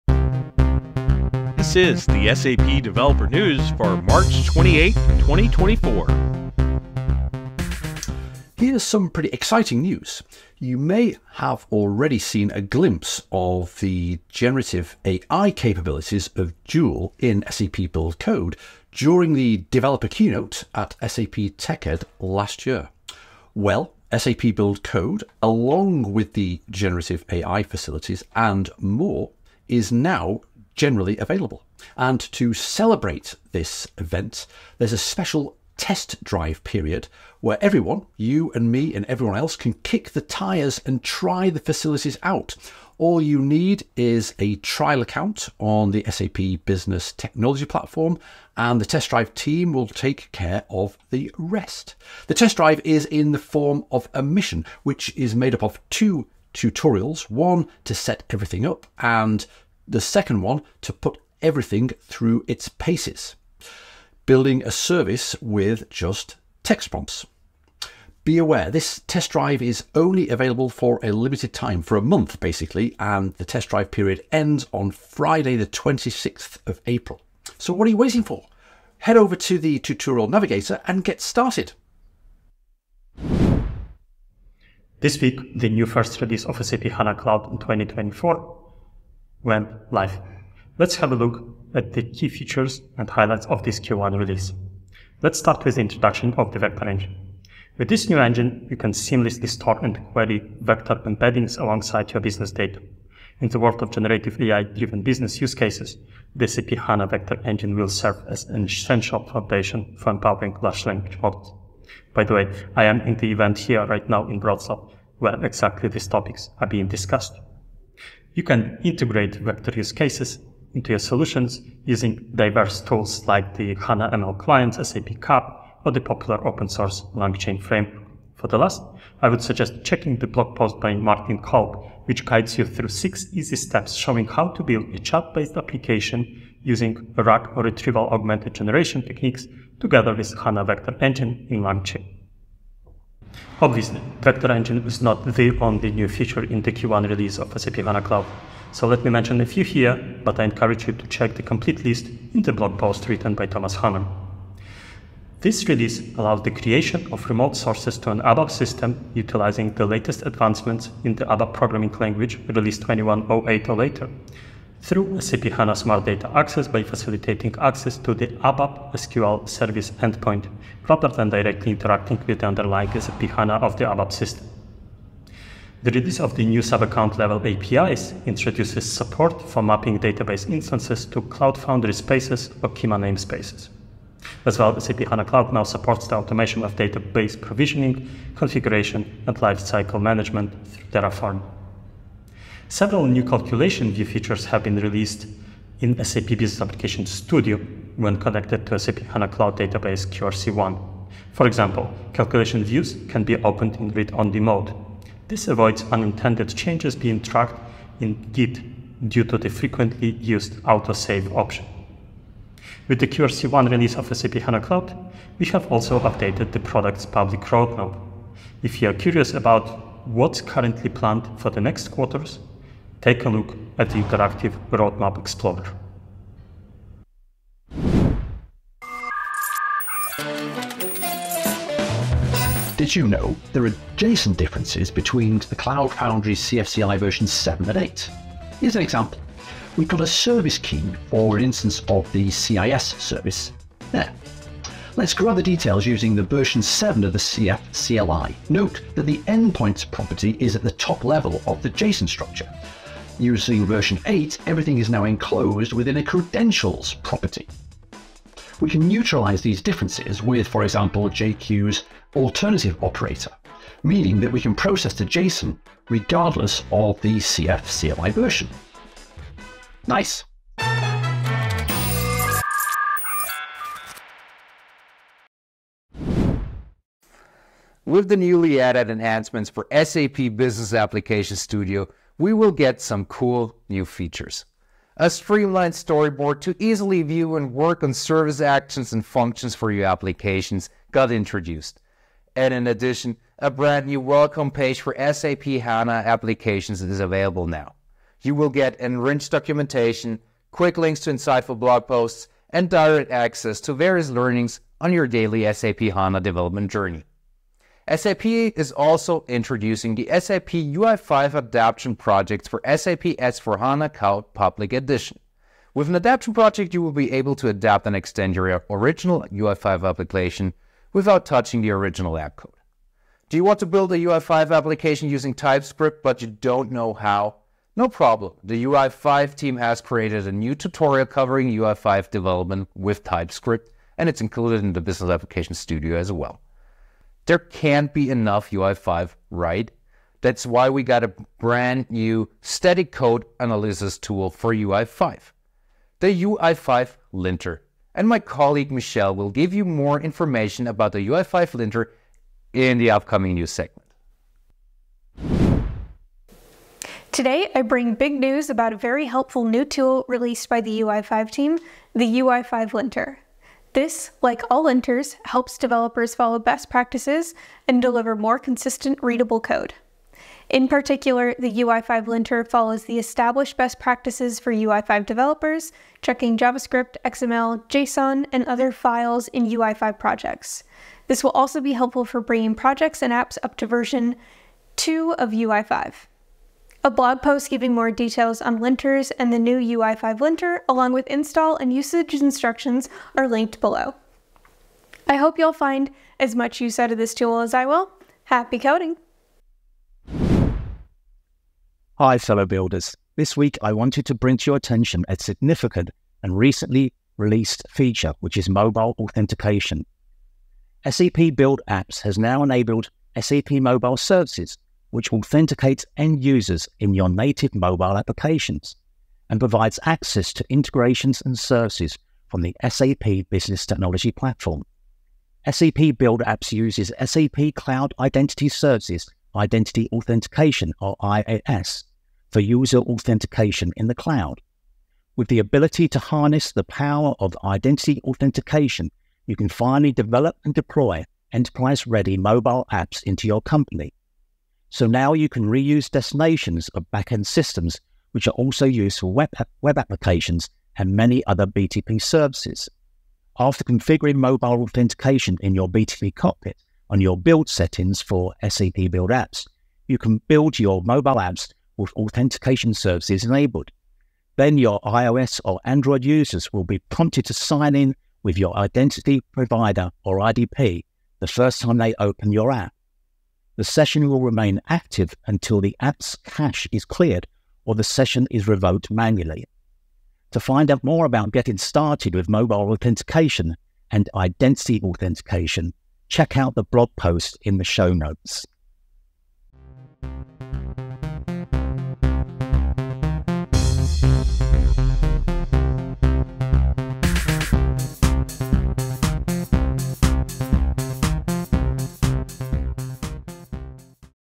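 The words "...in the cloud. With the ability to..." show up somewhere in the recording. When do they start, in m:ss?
7:13.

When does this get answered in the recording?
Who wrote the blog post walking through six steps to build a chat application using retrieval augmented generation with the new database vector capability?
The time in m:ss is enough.
2:10.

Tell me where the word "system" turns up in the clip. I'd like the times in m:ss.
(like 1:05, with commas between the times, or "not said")
2:38, 2:54, 7:27.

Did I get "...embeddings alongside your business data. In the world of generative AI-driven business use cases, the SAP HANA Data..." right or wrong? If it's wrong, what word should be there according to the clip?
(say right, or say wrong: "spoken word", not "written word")
wrong: "Vector", not "Data".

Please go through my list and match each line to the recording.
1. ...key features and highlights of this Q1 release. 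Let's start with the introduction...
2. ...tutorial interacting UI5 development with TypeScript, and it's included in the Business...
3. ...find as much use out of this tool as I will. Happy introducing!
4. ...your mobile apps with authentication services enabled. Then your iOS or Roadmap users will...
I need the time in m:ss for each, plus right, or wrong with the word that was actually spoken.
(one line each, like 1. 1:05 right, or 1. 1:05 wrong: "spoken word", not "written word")
1. 1:32 right
2. 5:30 wrong: "covering", not "interacting"
3. 6:35 wrong: "coding", not "introducing"
4. 7:40 wrong: "Android", not "Roadmap".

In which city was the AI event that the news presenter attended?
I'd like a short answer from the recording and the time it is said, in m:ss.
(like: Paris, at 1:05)
Wrocław, at 1:54.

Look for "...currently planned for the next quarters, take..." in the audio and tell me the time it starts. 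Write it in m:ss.
3:40.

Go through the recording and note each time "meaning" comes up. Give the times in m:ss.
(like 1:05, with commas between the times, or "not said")
4:23.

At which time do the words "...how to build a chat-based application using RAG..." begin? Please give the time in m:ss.
2:14.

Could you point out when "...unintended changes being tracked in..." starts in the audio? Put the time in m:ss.
3:25.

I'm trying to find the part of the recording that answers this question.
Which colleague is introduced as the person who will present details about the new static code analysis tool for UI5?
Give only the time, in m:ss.
5:48.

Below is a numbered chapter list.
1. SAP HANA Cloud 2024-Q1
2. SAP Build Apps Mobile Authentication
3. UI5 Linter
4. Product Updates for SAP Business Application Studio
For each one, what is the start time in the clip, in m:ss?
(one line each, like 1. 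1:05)
1. 1:26
2. 6:44
3. 6:00
4. 4:40.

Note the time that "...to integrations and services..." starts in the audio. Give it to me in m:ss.
7:00.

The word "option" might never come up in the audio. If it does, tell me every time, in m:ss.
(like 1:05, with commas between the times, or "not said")
3:31.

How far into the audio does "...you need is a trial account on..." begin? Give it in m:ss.
0:43.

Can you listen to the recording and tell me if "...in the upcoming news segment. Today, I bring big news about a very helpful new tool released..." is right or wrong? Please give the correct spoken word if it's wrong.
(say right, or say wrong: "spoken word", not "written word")
right.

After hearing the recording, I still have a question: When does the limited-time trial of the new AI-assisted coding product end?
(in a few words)
Friday the 26th of April.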